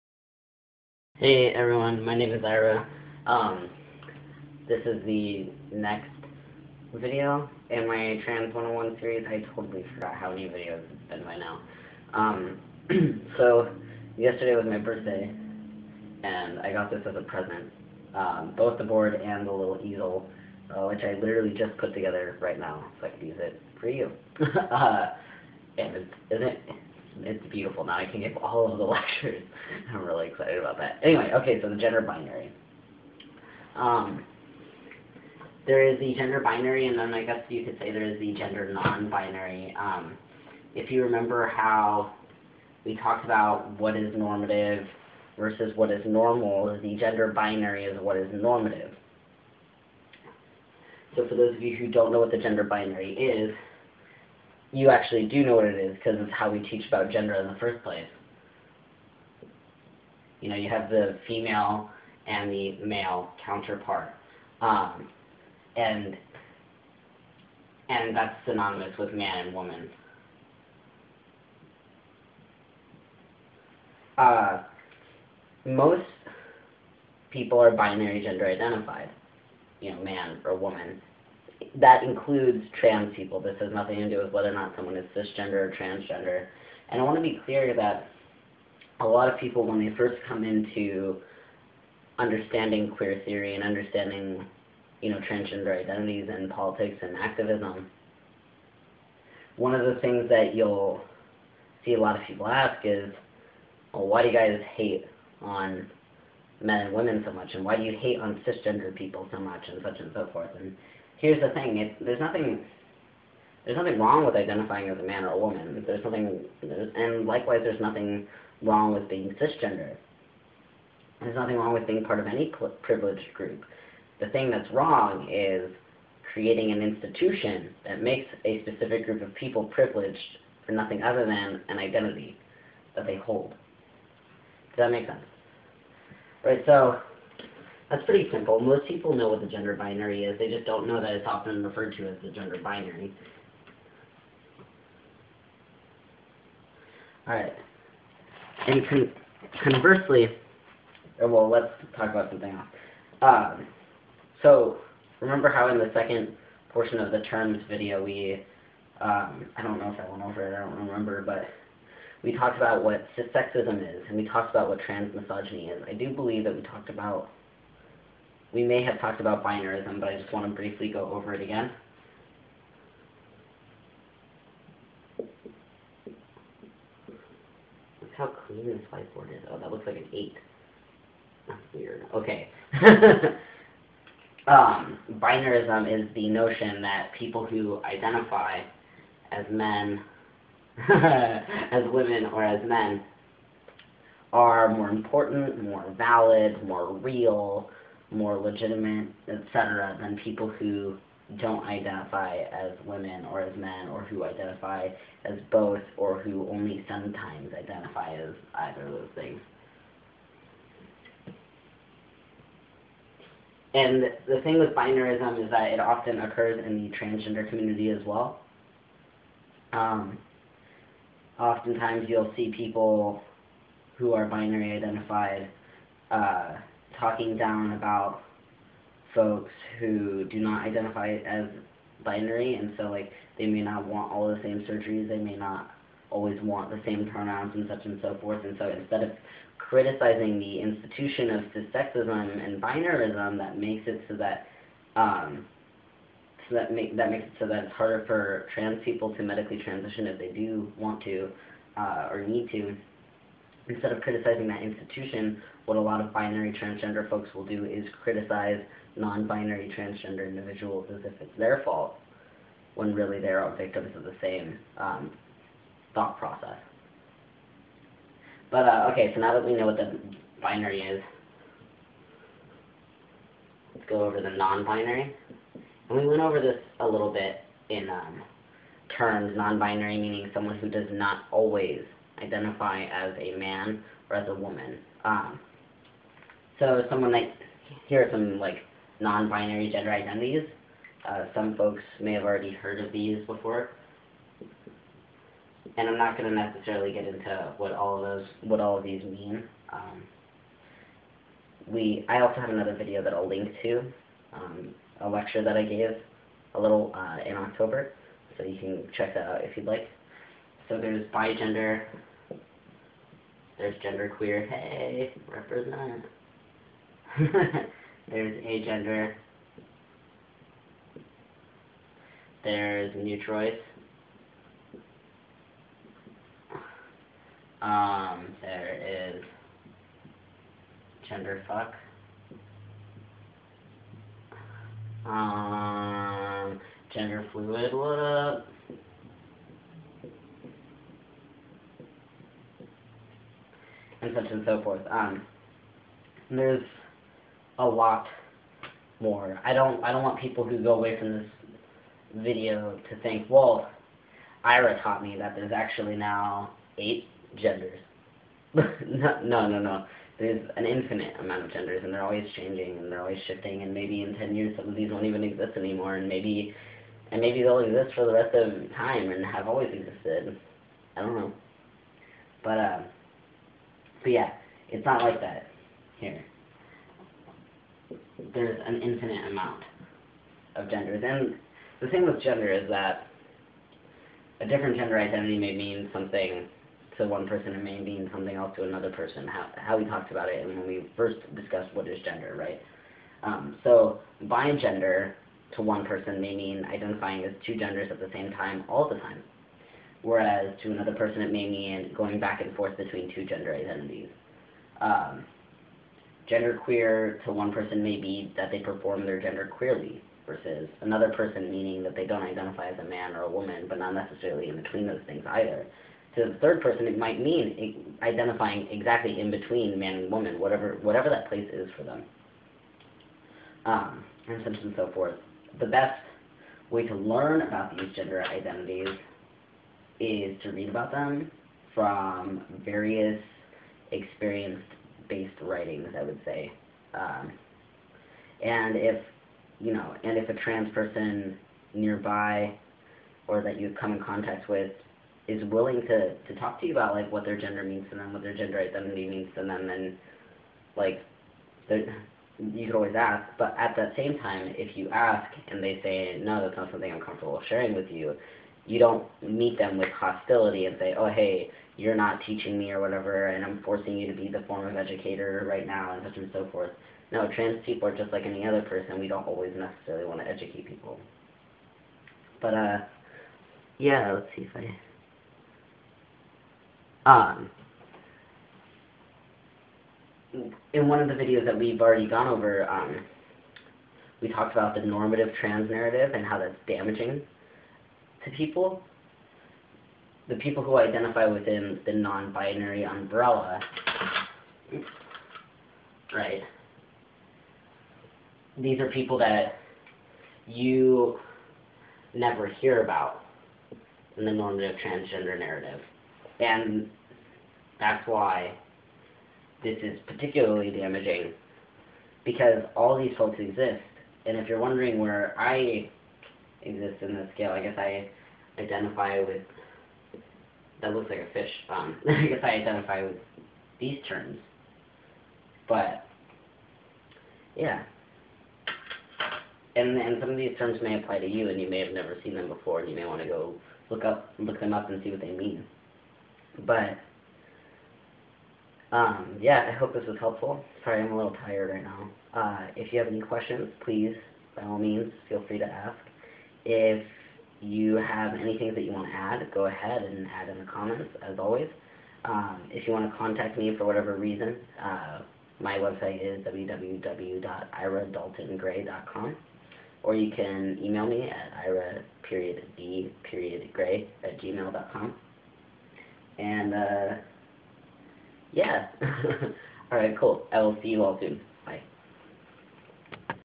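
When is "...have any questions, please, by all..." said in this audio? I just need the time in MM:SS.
09:02.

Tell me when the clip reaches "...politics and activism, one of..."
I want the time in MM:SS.
01:36.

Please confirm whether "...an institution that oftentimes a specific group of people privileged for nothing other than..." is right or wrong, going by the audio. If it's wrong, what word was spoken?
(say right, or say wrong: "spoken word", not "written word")
wrong: "makes", not "oftentimes".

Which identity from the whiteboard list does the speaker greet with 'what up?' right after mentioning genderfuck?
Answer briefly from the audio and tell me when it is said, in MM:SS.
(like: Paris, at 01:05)
Gender fluid, at 05:36.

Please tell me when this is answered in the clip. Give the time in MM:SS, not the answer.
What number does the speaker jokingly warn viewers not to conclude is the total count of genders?
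05:56.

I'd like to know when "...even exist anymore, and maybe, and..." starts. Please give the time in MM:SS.
06:05.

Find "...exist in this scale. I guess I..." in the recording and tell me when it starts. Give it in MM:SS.
08:36.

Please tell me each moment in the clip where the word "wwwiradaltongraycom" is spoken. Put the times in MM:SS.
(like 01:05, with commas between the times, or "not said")
09:16.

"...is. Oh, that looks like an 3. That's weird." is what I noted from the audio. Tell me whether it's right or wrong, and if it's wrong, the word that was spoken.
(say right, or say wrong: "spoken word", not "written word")
wrong: "8", not "3".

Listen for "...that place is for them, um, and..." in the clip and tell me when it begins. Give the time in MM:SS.
07:01.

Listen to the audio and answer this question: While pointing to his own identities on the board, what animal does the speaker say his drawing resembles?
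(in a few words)
A fish.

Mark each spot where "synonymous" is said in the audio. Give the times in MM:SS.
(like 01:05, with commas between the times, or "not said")
01:08.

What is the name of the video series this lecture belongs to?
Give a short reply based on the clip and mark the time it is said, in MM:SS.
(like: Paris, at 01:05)
Trans 101, at 00:08.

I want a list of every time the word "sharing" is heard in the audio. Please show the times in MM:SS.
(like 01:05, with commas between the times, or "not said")
07:37.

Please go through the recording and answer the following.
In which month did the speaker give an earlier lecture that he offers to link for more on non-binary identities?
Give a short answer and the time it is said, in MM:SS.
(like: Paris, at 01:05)
October, at 05:07.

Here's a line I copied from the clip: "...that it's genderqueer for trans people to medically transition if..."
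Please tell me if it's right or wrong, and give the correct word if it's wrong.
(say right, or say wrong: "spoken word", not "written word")
wrong: "harder", not "genderqueer".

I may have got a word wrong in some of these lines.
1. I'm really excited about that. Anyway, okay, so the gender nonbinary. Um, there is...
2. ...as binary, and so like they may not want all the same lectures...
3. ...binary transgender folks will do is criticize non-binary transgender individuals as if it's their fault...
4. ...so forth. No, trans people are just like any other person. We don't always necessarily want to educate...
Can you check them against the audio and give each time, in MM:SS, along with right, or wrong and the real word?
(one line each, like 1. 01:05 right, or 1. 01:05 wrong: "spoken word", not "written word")
1. 00:29 wrong: "binary", not "nonbinary"
2. 03:51 wrong: "surgeries", not "lectures"
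3. 04:16 right
4. 07:46 right.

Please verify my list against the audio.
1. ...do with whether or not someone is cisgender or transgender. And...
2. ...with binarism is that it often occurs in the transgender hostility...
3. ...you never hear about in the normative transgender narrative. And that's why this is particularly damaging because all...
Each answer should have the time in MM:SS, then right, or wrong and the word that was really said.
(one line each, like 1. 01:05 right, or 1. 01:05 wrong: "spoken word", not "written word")
1. 01:24 right
2. 03:34 wrong: "community", not "hostility"
3. 08:20 right.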